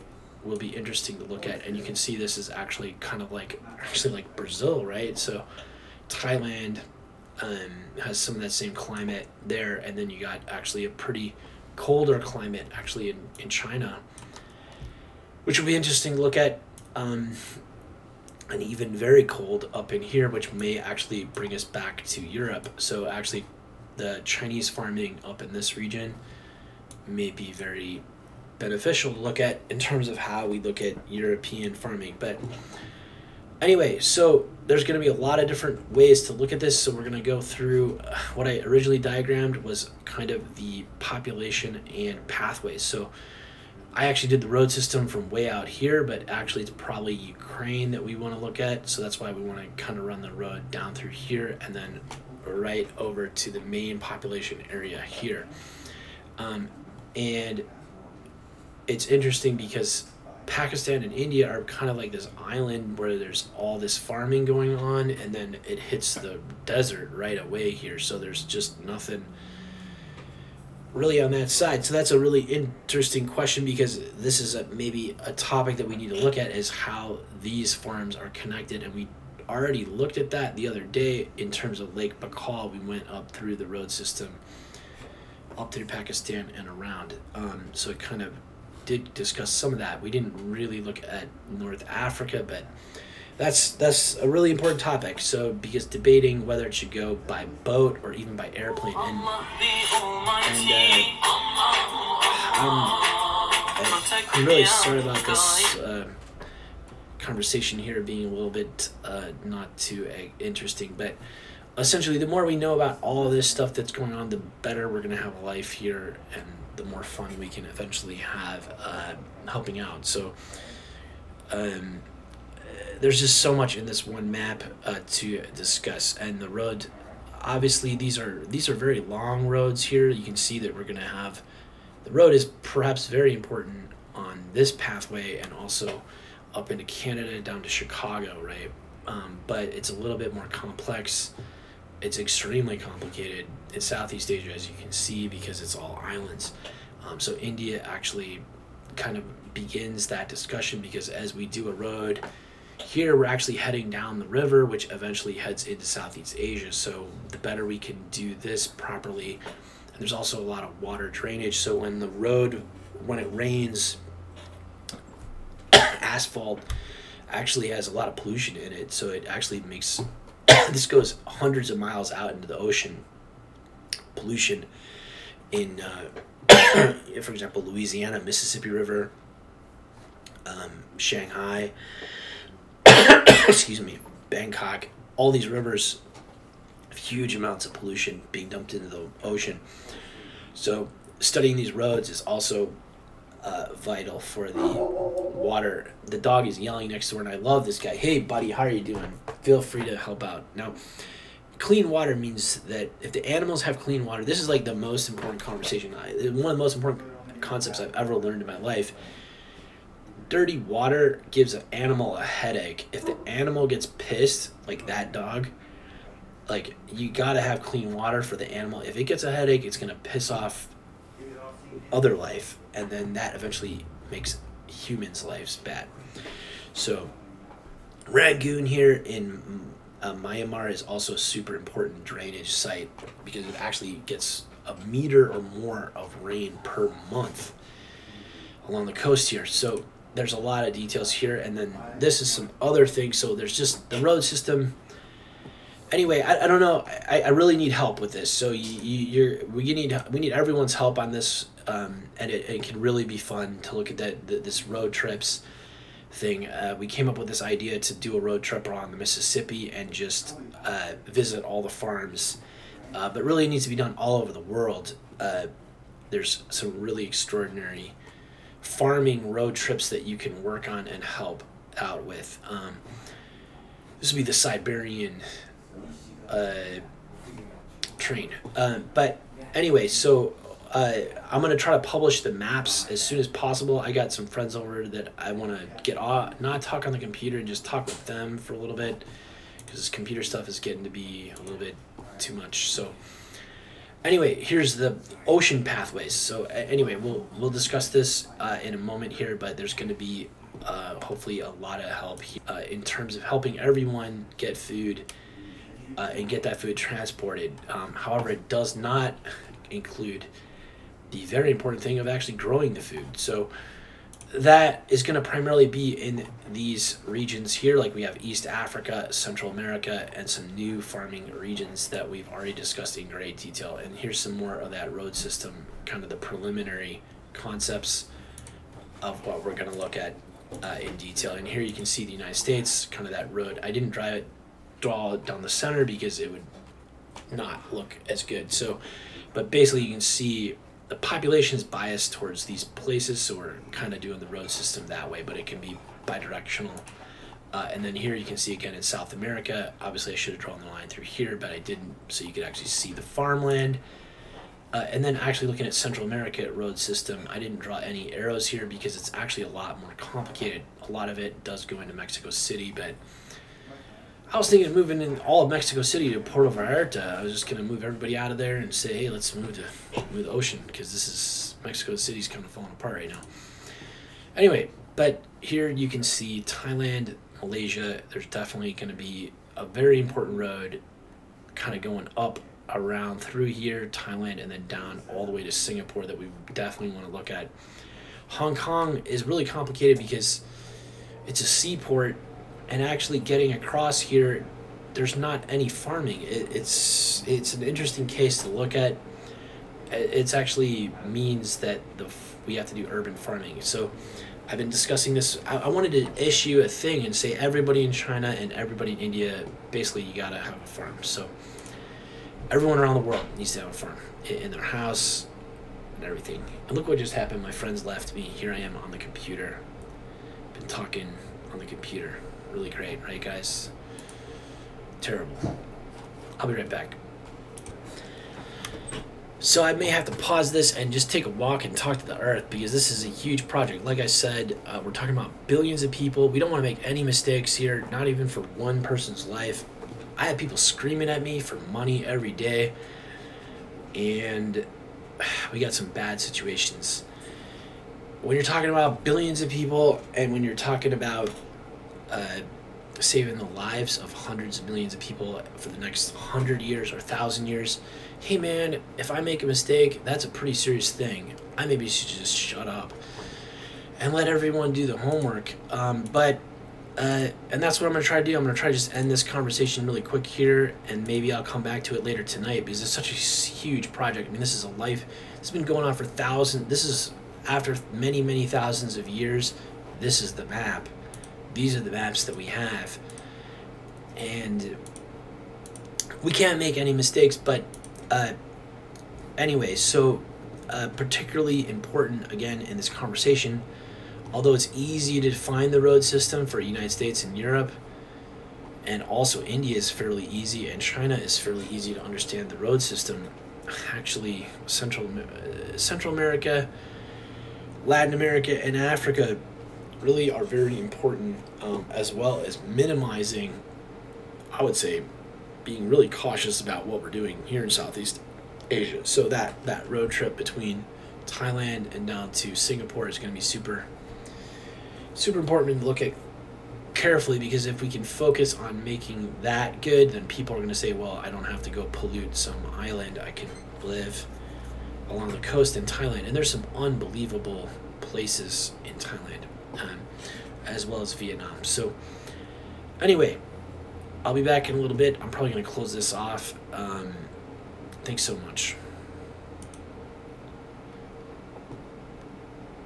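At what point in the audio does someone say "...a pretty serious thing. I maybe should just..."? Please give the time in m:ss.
7:40.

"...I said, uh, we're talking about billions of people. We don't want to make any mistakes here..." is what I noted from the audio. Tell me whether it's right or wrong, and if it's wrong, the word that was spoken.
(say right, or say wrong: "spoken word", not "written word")
right.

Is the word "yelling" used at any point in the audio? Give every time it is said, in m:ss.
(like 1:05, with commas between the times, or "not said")
3:16.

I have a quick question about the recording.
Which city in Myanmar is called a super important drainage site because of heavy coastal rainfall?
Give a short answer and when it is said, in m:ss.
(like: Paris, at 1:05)
Rangoon, at 3:48.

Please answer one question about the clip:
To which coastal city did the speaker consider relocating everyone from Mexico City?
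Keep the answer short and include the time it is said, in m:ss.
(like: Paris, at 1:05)
Puerto Vallarta, at 6:06.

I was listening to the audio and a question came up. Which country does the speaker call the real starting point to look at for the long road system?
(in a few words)
Ukraine.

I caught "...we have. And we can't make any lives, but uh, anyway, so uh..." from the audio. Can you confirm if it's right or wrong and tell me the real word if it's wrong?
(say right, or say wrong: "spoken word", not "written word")
wrong: "mistakes", not "lives".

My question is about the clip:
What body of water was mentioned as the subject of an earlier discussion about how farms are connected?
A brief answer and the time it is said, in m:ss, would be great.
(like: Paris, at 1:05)
Lake Baikal, at 1:21.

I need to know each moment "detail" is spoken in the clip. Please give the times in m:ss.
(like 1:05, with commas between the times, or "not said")
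4:00, 5:23, 5:30.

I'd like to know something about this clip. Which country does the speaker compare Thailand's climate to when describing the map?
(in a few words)
Brazil.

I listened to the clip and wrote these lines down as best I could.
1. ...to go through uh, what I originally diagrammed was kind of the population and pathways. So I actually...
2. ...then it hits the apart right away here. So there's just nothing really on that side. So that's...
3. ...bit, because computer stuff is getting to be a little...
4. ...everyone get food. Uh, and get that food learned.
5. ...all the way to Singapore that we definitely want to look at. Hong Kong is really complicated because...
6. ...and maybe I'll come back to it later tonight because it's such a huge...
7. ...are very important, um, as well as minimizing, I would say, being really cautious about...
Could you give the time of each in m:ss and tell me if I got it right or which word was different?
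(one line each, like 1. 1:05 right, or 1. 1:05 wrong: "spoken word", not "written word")
1. 0:37 right
2. 1:05 wrong: "desert", not "apart"
3. 4:48 right
4. 5:03 wrong: "transported", not "learned"
5. 6:25 right
6. 7:50 right
7. 8:30 right.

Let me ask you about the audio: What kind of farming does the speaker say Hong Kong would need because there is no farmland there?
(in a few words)
Urban farming.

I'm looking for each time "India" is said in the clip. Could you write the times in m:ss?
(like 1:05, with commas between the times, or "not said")
1:01, 2:27, 6:48, 8:19.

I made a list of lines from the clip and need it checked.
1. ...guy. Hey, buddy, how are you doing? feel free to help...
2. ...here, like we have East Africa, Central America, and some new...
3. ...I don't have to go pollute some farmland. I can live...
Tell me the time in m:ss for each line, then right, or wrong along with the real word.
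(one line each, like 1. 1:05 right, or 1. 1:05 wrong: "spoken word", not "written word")
1. 3:17 right
2. 5:17 right
3. 8:51 wrong: "island", not "farmland".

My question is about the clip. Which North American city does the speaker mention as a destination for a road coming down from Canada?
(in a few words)
Chicago.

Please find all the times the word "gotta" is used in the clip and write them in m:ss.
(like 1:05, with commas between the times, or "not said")
3:37, 6:50.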